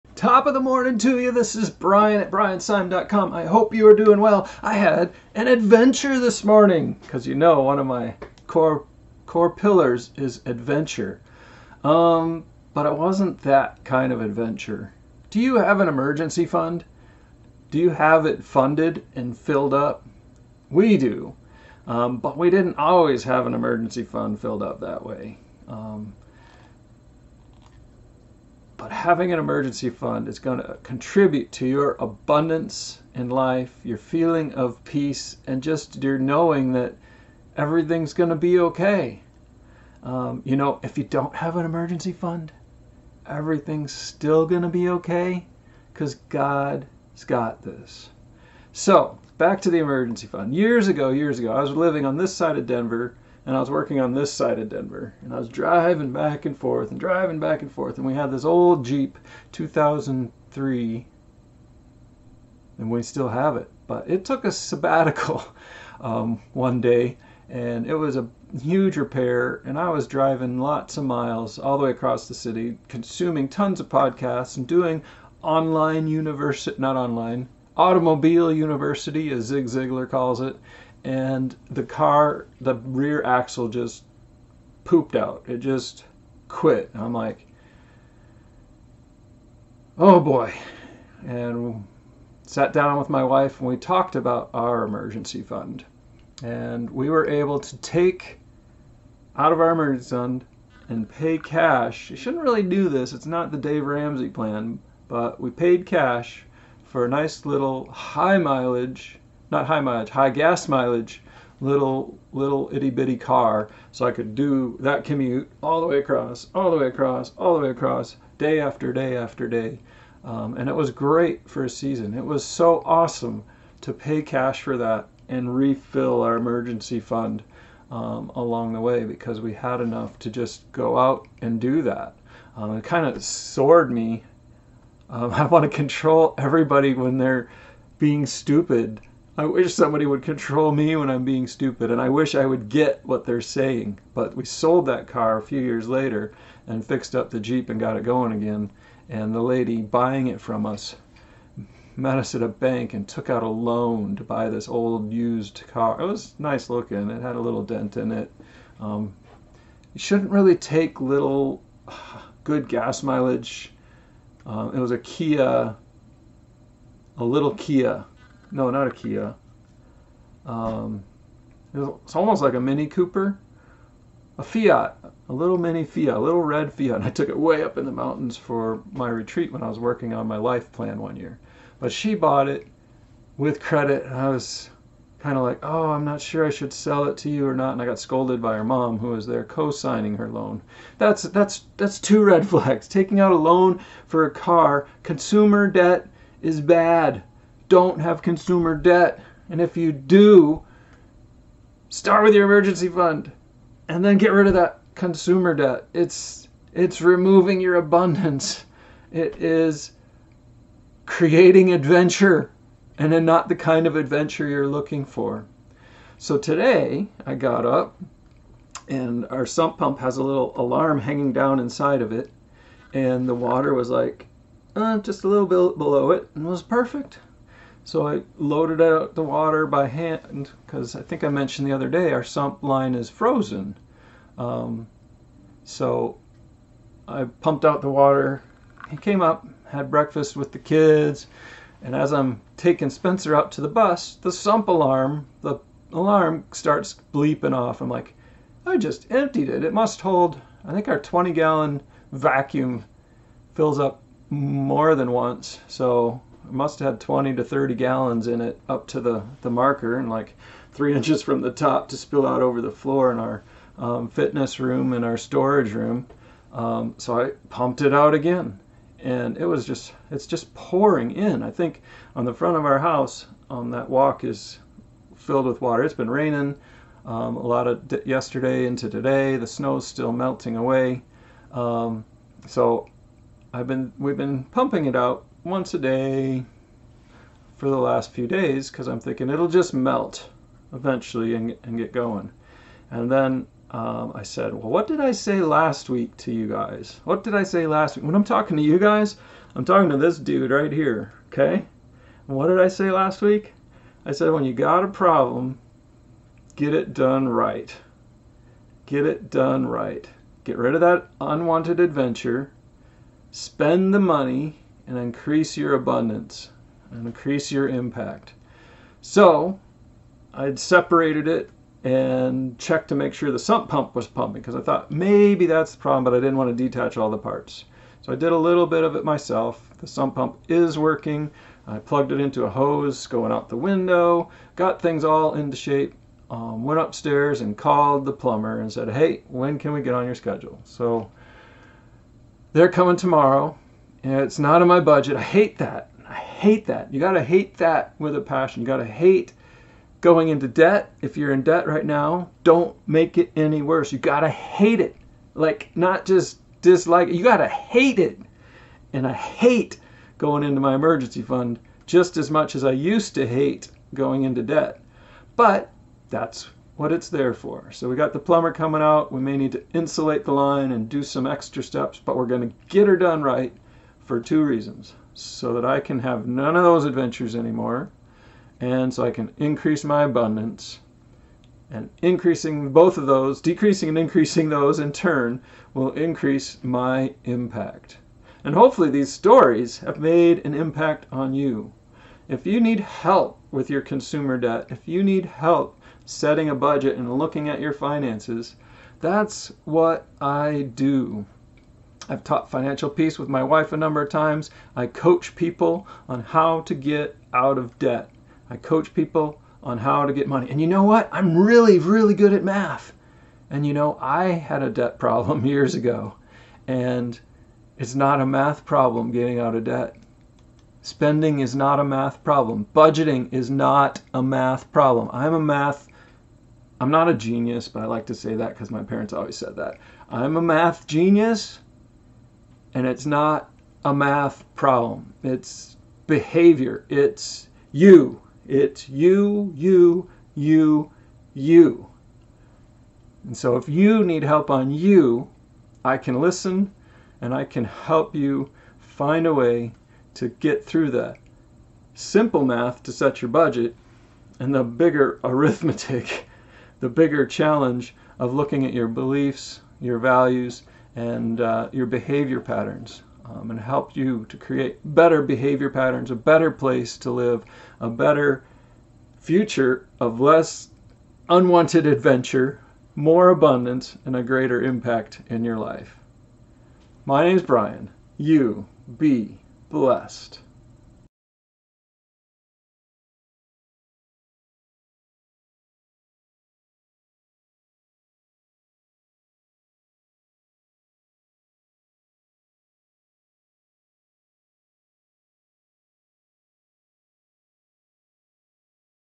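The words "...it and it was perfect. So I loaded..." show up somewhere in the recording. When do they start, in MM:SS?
03:46.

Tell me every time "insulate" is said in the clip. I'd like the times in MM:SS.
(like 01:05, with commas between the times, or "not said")
06:09.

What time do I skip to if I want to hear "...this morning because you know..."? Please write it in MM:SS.
00:06.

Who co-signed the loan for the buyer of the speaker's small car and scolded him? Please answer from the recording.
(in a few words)
Her mom.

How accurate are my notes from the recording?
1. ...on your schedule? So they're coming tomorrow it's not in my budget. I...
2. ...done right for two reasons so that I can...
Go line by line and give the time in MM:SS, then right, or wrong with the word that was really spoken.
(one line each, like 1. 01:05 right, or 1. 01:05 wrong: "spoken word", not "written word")
1. 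05:39 right
2. 06:12 right.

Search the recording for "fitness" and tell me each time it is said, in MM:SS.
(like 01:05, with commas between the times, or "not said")
04:24.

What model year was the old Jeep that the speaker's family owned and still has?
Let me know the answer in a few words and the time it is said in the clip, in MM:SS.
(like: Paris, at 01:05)
2003, at 00:59.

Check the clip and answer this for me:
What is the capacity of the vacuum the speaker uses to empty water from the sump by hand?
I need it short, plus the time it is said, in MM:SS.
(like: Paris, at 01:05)
20 gallons, at 04:10.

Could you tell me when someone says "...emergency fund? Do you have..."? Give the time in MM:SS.
00:15.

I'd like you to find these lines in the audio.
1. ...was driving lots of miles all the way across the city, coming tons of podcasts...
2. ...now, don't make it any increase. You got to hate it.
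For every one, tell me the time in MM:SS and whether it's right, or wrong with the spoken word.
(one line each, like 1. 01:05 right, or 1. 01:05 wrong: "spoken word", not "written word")
1. 01:09 wrong: "consuming", not "coming"
2. 05:51 wrong: "worse", not "increase".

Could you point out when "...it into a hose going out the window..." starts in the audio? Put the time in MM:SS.
05:32.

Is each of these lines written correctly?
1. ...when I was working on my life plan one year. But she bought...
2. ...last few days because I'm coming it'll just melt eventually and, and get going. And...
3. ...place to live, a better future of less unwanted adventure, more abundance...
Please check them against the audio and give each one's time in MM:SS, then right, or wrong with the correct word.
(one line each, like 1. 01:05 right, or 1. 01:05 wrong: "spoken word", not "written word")
1. 02:59 right
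2. 04:47 wrong: "thinking", not "coming"
3. 07:46 right.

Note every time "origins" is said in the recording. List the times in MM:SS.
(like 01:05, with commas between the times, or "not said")
not said.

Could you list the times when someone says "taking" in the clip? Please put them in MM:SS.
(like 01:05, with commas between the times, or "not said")
03:12, 04:02.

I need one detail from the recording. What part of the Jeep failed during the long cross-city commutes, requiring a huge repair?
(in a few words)
The rear axle.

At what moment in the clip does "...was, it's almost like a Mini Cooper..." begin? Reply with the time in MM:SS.
02:51.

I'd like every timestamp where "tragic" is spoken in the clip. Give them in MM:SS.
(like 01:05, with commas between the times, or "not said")
not said.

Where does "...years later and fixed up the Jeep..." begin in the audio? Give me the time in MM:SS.
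02:25.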